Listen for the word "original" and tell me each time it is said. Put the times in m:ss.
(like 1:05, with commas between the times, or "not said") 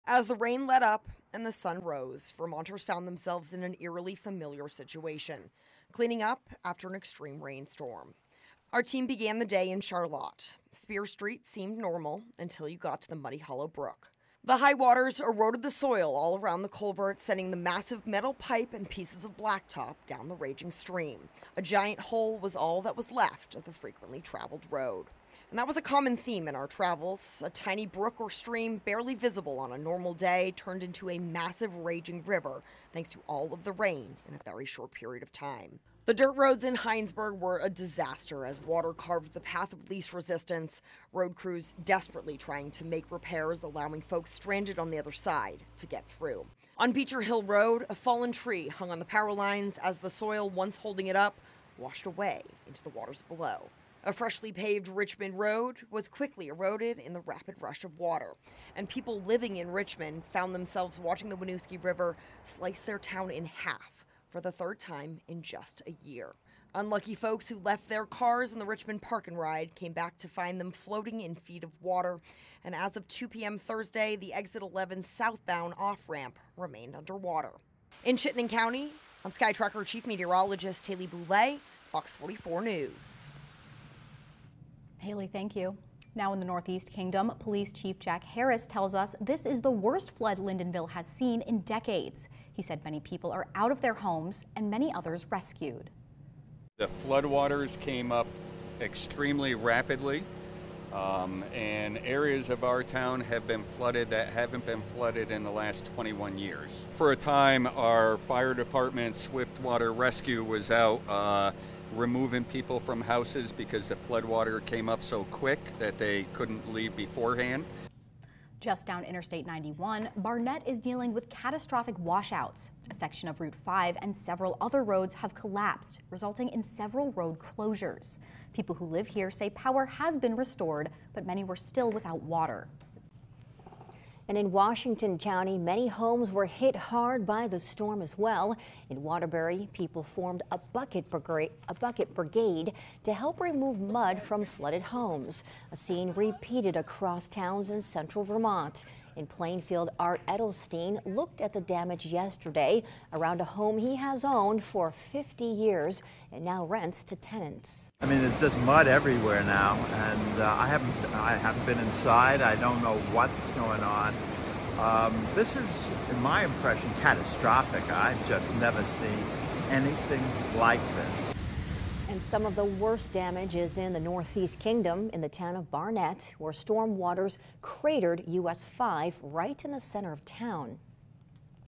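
not said.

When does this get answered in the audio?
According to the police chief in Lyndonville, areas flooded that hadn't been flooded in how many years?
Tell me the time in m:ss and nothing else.
1:45.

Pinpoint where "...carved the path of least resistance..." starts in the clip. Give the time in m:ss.
0:38.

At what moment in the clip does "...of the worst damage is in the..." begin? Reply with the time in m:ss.
2:52.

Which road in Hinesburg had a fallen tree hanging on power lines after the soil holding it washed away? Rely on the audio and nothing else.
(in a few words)
Beecher Hill Road.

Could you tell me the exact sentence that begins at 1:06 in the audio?
Unlucky folks who left their cars in the Richmond Park and Ride came back to find them floating in feet of water.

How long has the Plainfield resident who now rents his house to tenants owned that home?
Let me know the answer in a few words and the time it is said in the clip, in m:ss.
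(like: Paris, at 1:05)
50 years, at 2:34.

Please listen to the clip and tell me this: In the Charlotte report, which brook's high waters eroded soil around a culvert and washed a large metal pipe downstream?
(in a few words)
Muddy Hollow Brook.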